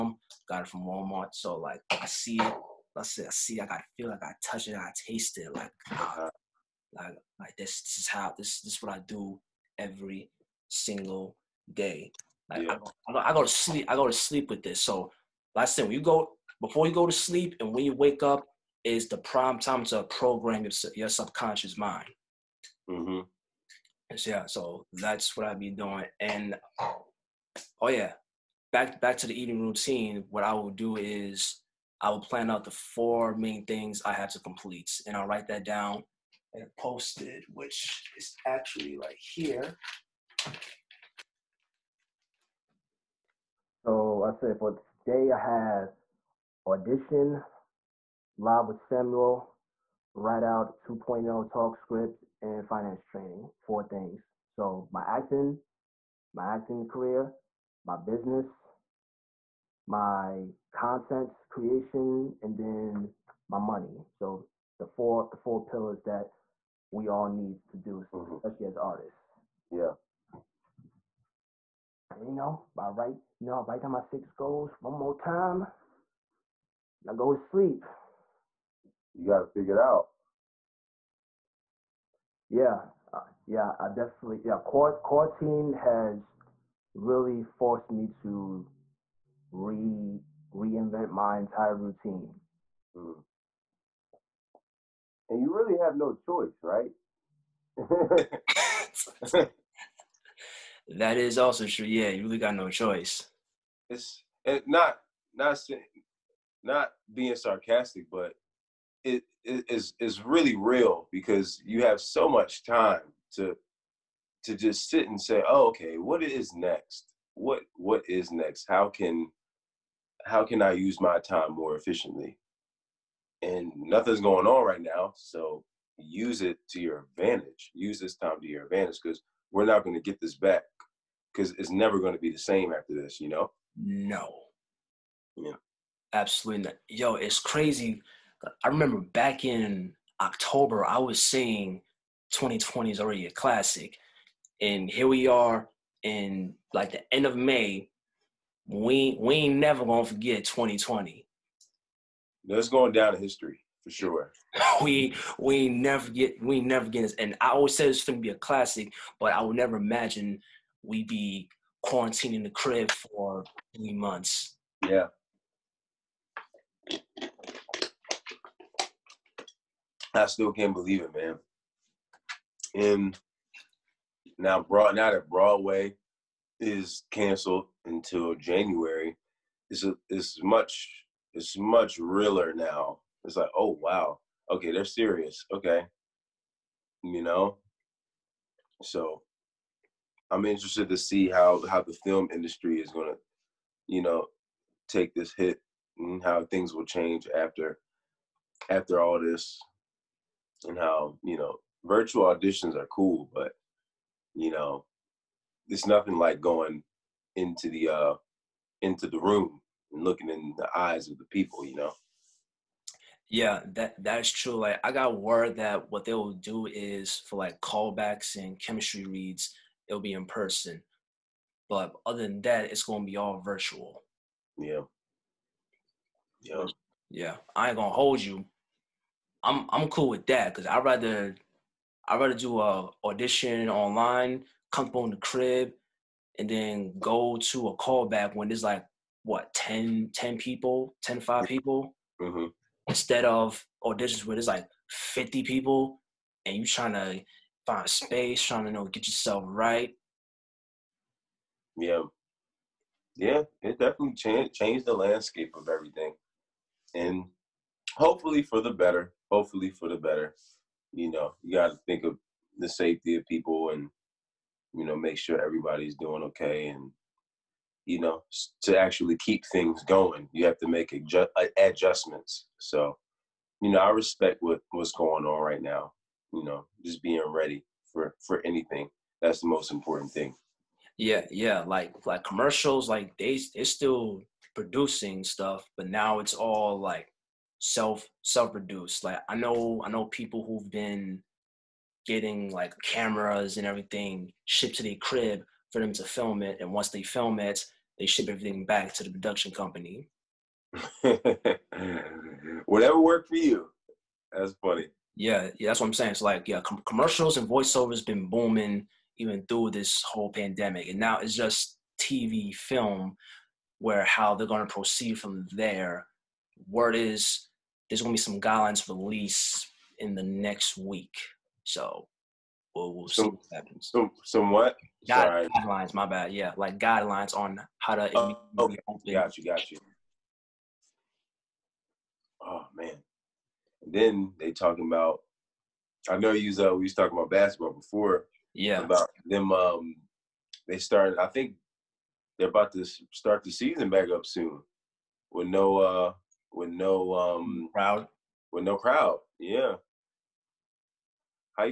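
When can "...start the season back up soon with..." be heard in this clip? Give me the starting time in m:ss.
5:43.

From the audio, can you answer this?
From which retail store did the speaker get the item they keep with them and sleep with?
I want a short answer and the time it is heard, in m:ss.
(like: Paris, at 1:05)
Walmart, at 0:00.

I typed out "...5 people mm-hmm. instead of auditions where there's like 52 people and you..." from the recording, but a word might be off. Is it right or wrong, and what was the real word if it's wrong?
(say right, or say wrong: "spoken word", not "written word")
wrong: "50", not "52".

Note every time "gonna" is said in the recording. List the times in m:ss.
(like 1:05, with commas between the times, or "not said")
2:29, 2:38, 3:12, 3:42, 3:47.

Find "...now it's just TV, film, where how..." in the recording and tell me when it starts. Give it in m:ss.
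5:10.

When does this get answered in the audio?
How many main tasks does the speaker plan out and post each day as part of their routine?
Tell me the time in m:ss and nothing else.
0:32.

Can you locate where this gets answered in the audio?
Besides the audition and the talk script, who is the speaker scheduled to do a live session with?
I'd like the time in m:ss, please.
0:48.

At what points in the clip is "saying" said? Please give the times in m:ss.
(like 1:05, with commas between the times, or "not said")
2:21, 5:05.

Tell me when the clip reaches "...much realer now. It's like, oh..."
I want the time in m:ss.
3:01.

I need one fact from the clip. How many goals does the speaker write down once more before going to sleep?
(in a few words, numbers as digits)
6.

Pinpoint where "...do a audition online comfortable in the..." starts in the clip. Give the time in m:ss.
3:52.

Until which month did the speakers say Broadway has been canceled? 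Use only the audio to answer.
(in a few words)
January.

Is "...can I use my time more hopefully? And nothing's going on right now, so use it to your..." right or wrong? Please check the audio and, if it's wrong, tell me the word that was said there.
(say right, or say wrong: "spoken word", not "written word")
wrong: "efficiently", not "hopefully".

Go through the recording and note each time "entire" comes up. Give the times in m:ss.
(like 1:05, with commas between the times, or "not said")
1:31.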